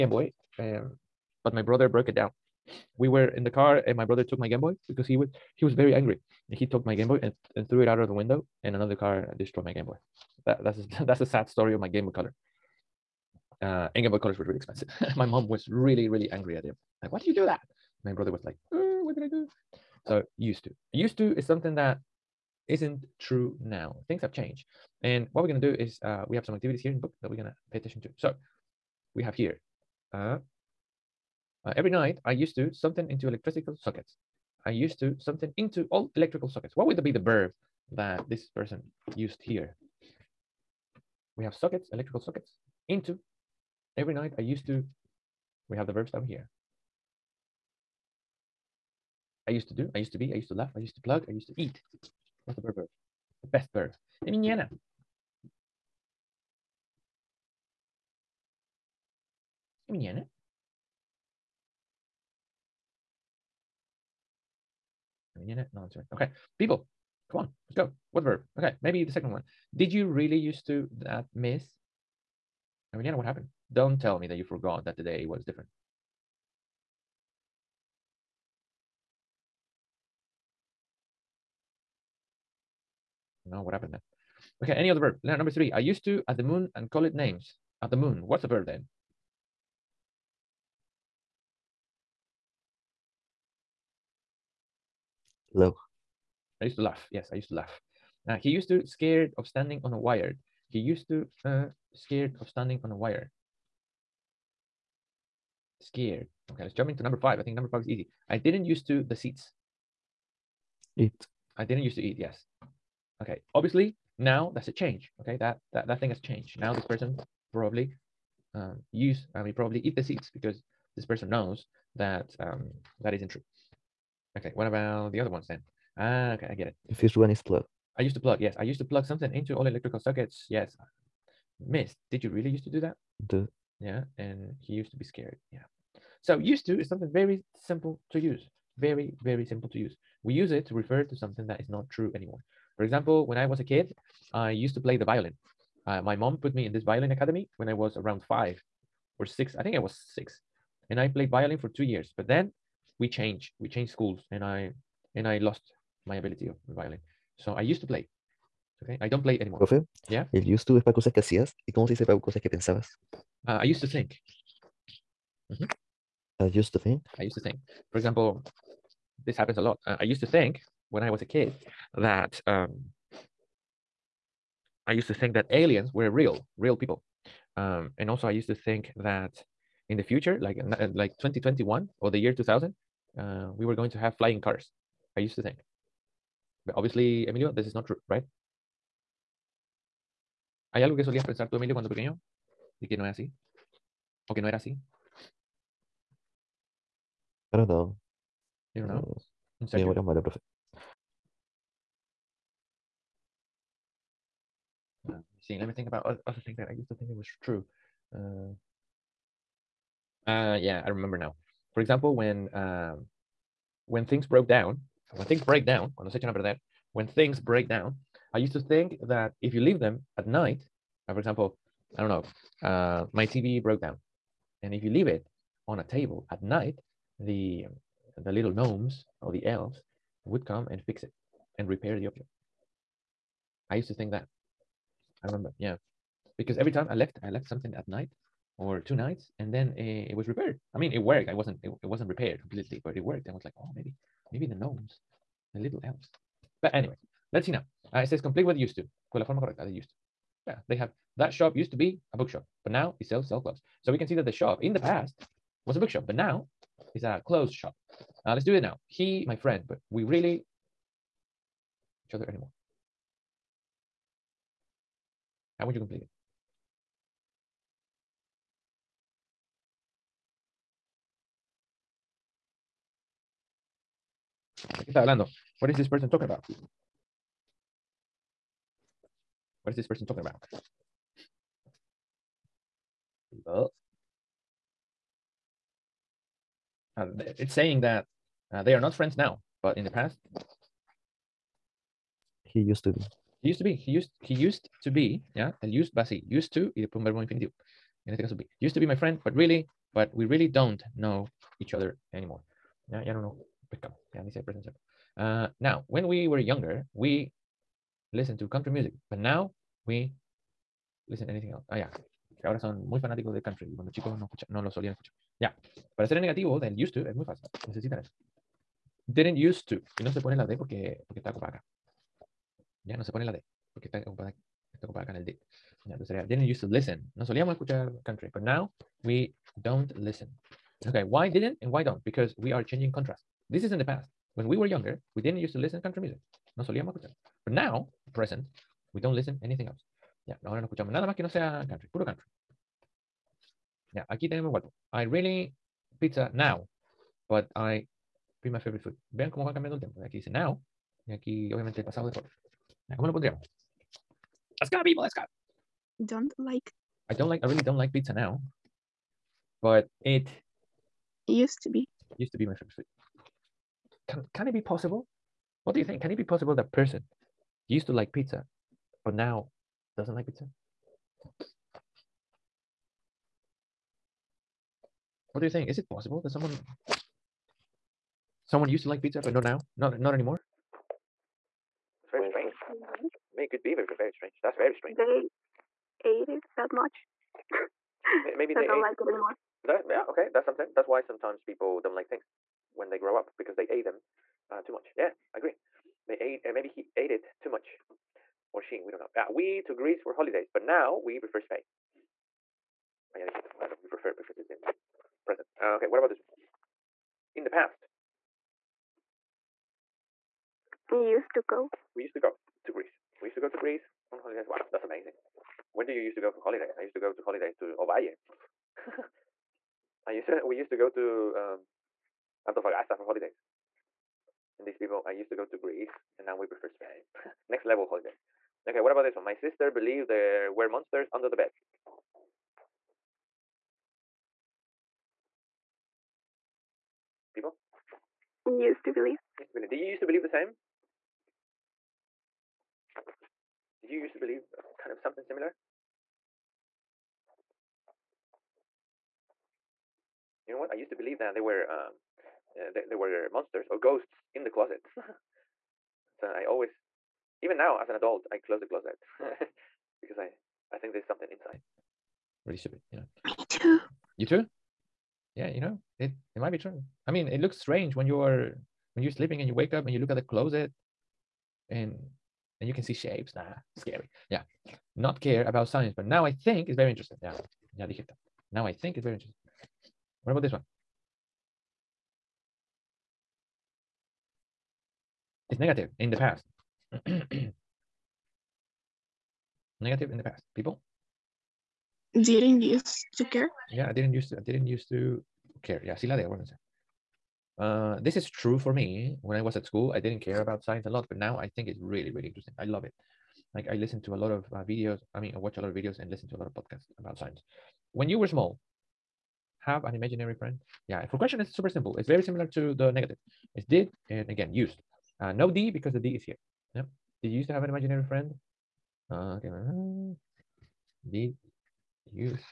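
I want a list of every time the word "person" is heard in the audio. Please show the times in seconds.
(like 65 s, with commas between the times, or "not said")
38 s, 116 s, 121 s, 275 s, 279 s, 366 s.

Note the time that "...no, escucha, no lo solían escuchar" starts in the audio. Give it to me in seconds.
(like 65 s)
314 s.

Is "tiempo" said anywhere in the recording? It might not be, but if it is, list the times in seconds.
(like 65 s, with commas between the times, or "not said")
349 s.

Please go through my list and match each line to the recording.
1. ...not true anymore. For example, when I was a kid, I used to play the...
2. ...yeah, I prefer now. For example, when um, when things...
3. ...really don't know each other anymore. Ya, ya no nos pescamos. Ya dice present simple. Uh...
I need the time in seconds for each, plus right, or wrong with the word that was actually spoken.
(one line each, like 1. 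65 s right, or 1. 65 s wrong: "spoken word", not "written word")
1. 141 s right
2. 210 s wrong: "remember", not "prefer"
3. 300 s right.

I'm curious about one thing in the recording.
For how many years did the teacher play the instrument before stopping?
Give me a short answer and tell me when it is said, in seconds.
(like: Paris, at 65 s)
2, at 151 s.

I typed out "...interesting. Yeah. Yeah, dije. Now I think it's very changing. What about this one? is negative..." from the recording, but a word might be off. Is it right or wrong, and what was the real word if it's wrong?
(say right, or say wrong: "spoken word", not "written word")
wrong: "interesting", not "changing".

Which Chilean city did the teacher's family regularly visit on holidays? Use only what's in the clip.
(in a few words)
Antofagasta.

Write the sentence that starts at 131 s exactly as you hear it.
Miss, did you really used to do that?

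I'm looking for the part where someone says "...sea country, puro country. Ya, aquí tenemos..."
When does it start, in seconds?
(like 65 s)
341 s.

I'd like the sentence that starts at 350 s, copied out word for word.
Aquí dice now, y aquí obviamente el pasado de forma.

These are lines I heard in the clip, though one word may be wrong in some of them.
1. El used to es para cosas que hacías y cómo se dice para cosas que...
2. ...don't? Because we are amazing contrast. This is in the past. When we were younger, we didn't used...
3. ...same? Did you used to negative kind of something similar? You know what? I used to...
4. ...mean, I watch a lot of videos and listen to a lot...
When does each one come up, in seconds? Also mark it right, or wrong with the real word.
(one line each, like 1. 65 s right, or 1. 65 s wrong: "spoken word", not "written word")
1. 160 s right
2. 331 s wrong: "changing", not "amazing"
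3. 440 s wrong: "believe", not "negative"
4. 505 s right.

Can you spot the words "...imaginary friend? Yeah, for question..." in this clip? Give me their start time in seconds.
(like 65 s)
509 s.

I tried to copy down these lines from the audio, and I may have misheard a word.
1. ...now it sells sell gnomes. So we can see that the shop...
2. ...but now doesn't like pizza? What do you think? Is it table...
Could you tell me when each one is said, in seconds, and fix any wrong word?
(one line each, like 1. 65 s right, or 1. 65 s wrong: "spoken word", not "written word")
1. 252 s wrong: "clothes", not "gnomes"
2. 369 s wrong: "possible", not "table".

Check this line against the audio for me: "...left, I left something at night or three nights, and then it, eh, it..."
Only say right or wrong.
wrong.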